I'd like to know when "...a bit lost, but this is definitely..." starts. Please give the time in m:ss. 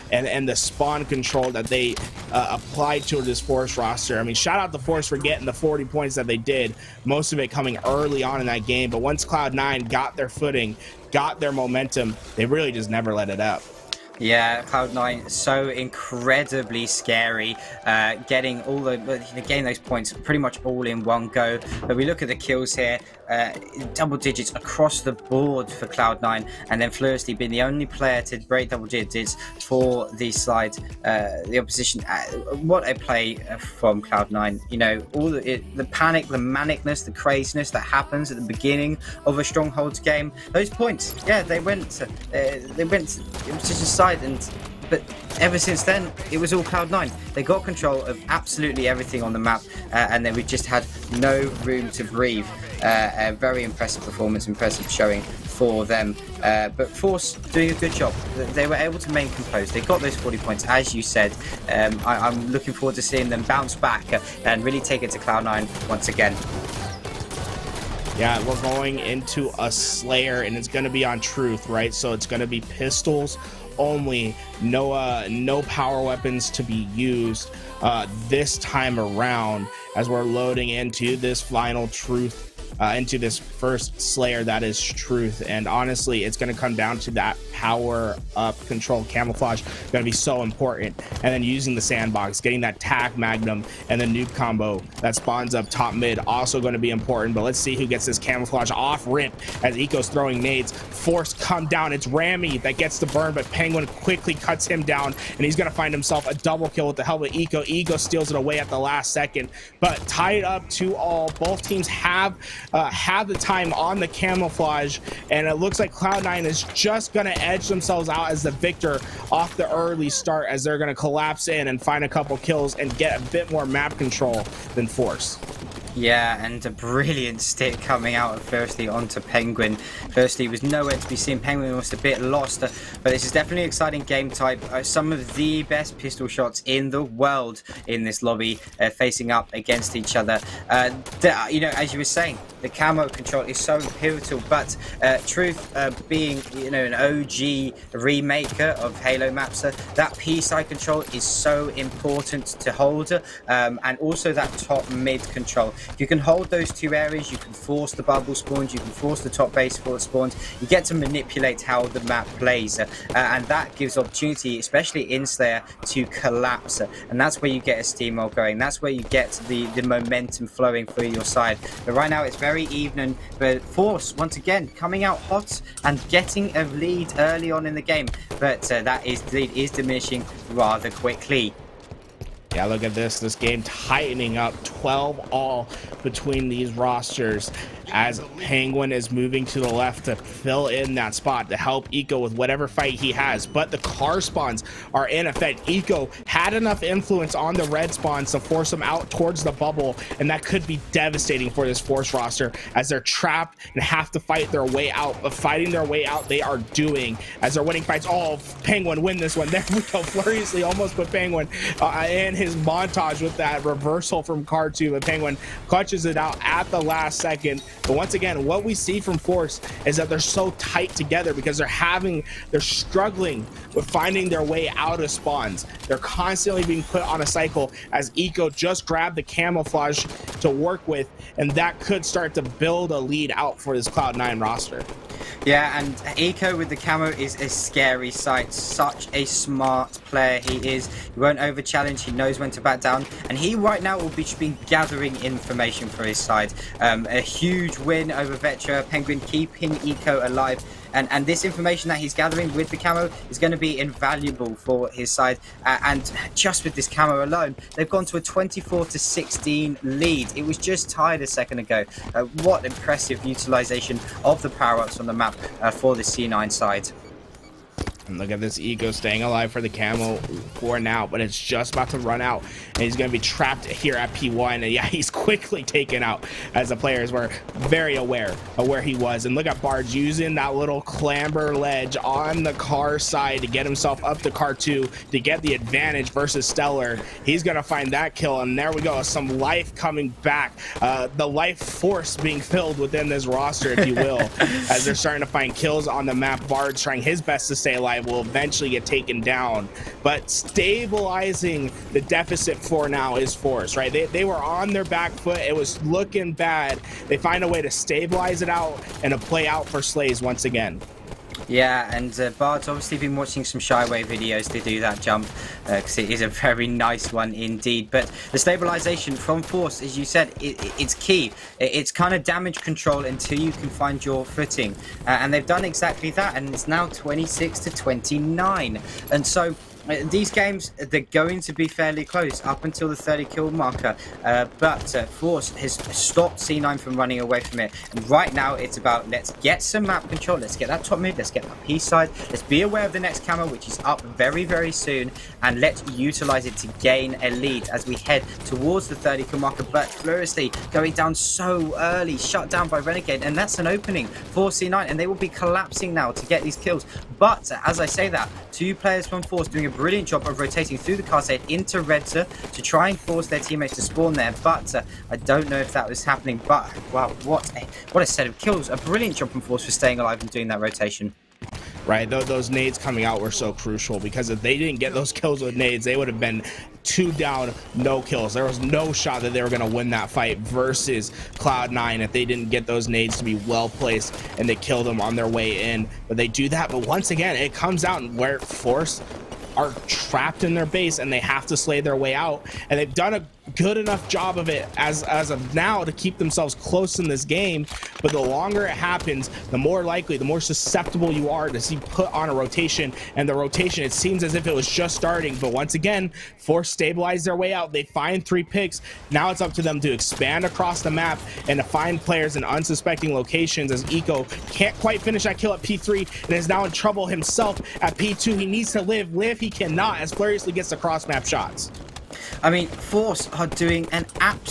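2:11.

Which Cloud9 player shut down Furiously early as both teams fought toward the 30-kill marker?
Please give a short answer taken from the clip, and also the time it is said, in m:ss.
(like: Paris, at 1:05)
Renegade, at 5:52.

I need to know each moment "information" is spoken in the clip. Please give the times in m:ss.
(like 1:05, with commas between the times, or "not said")
4:05, 4:11.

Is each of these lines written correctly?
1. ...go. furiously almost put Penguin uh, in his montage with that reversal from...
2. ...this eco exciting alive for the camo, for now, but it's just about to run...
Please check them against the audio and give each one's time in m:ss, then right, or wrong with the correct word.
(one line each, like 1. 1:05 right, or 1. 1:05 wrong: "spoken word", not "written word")
1. 3:29 right
2. 4:28 wrong: "staying", not "exciting".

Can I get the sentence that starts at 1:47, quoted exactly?
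Eco steals it away at the last second, but tied up to all.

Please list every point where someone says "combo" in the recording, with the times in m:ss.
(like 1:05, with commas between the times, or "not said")
1:34.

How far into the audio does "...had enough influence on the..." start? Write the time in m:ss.
3:16.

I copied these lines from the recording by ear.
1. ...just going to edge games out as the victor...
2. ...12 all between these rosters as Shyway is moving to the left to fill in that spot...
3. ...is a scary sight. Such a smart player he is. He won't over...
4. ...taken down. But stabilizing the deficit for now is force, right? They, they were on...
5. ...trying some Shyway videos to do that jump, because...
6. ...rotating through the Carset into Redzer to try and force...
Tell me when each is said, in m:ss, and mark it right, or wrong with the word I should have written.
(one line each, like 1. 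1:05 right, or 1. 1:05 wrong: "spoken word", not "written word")
1. 1:56 wrong: "themselves", not "games"
2. 3:04 wrong: "Penguin", not "Shyway"
3. 3:57 right
4. 4:58 right
5. 5:13 wrong: "watching", not "trying"
6. 6:00 right.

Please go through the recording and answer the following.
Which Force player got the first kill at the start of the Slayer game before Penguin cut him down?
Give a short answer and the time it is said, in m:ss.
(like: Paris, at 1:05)
Rami, at 1:42.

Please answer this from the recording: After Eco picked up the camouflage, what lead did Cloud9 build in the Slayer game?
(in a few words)
24 to 16.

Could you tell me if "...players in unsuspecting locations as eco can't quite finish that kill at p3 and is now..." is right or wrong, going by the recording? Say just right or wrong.
right.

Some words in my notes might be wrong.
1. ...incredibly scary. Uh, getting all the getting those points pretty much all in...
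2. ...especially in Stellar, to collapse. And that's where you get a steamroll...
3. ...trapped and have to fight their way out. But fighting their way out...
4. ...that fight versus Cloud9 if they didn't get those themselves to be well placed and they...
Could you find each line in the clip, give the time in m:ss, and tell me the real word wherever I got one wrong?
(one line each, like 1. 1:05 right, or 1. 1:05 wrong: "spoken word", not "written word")
1. 0:15 right
2. 2:44 wrong: "Slayer", not "Stellar"
3. 3:22 right
4. 6:19 wrong: "nades", not "themselves".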